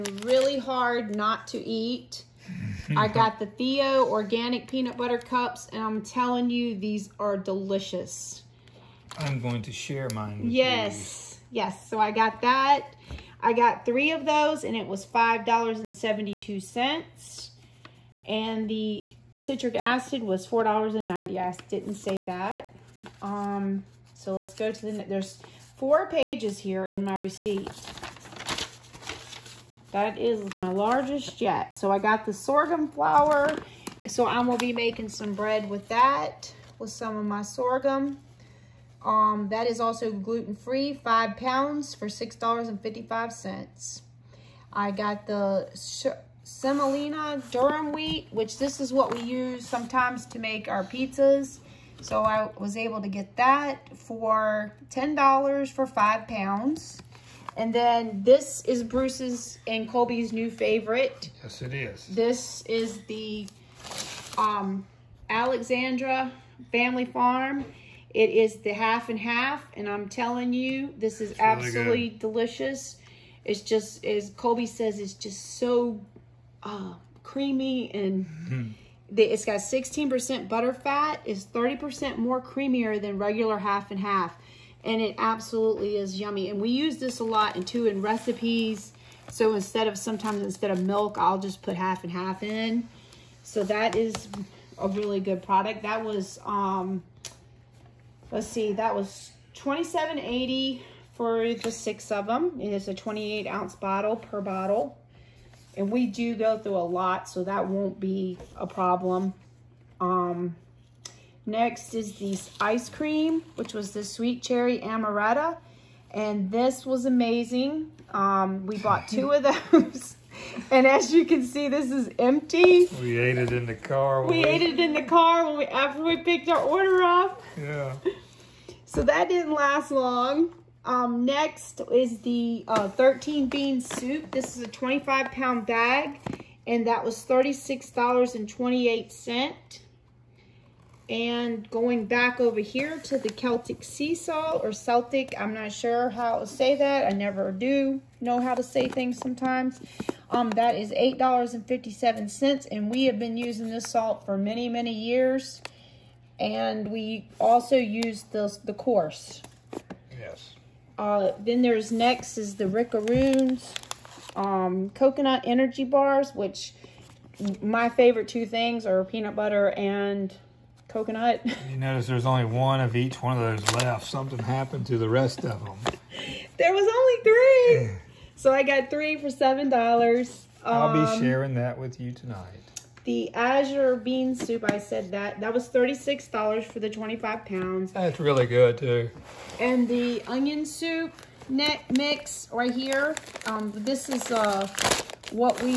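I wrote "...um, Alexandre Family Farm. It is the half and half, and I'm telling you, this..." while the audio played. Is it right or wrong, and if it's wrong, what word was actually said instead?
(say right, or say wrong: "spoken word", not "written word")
right.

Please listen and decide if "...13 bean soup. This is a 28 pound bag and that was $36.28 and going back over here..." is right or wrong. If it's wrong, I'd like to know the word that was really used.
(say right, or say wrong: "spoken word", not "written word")
wrong: "25", not "28".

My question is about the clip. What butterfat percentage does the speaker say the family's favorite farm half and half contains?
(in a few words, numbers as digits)
16%.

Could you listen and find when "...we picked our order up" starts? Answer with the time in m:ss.
2:06.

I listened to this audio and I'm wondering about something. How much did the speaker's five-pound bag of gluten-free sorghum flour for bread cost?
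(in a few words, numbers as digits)
$6.55.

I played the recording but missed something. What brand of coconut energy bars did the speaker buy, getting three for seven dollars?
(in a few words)
Rickaroons.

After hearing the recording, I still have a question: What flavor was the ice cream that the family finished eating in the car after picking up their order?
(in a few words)
Sweet cherry amaretto.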